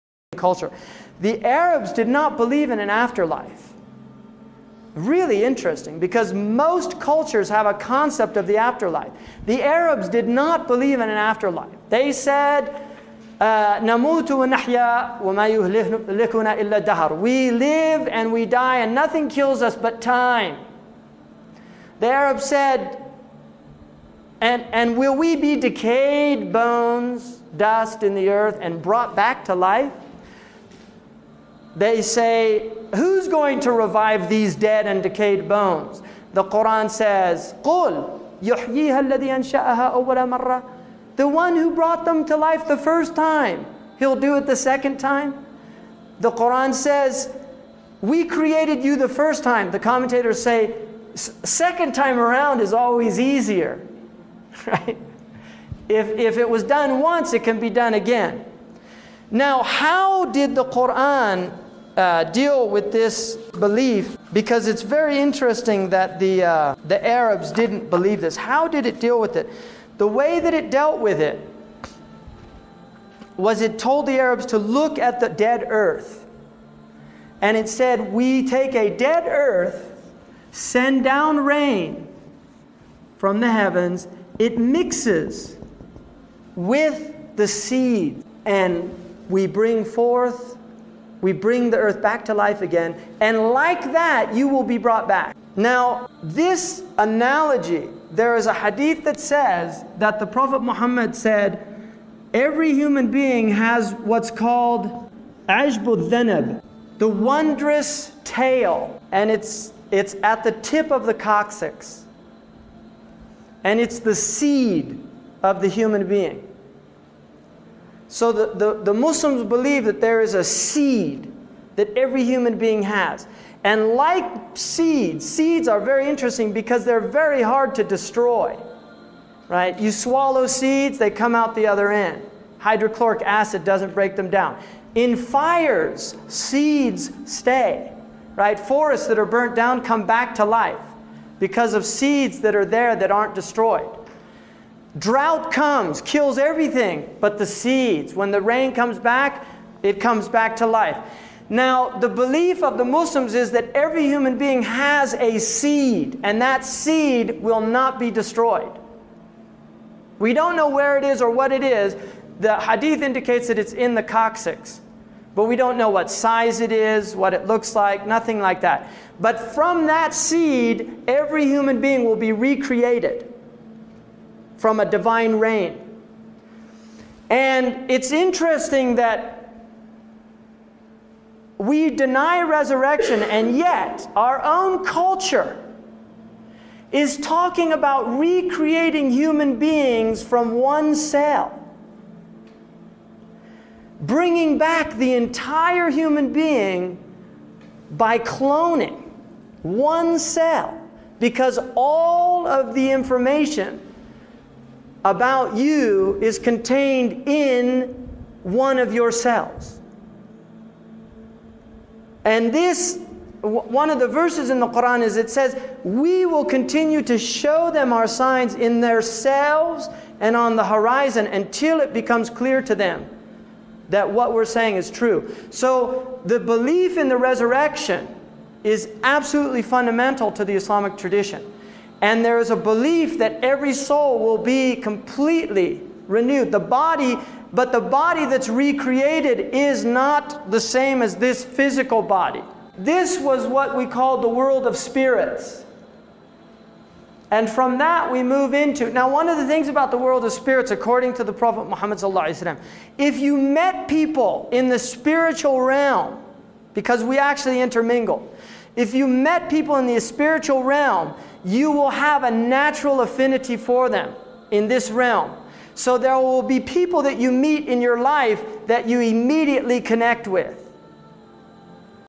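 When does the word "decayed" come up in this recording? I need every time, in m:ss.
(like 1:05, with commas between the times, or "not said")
0:25, 0:35.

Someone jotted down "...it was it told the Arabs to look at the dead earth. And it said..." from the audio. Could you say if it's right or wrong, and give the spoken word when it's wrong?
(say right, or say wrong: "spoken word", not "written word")
right.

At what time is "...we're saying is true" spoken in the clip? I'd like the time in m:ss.
3:44.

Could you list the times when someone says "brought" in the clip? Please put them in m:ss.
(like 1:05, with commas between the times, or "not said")
0:28, 0:41, 1:34.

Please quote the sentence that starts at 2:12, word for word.
Hydrochloric acid doesn't break them down.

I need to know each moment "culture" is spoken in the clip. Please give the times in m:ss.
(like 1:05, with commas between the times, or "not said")
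0:00, 0:07, 3:04.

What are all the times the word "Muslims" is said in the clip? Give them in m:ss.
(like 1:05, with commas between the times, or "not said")
1:58, 2:32.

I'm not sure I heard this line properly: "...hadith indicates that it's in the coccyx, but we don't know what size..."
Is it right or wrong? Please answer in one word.
right.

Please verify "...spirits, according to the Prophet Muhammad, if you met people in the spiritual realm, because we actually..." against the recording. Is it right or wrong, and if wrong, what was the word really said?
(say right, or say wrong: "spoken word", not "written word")
right.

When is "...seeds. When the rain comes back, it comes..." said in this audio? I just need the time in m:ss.
2:27.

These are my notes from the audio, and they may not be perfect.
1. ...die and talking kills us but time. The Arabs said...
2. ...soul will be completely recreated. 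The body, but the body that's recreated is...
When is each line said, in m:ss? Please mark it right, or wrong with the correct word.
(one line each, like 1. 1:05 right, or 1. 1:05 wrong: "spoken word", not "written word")
1. 0:18 wrong: "nothing", not "talking"
2. 3:53 wrong: "renewed", not "recreated".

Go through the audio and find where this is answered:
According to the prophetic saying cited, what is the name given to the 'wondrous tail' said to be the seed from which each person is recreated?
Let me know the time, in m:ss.
1:45.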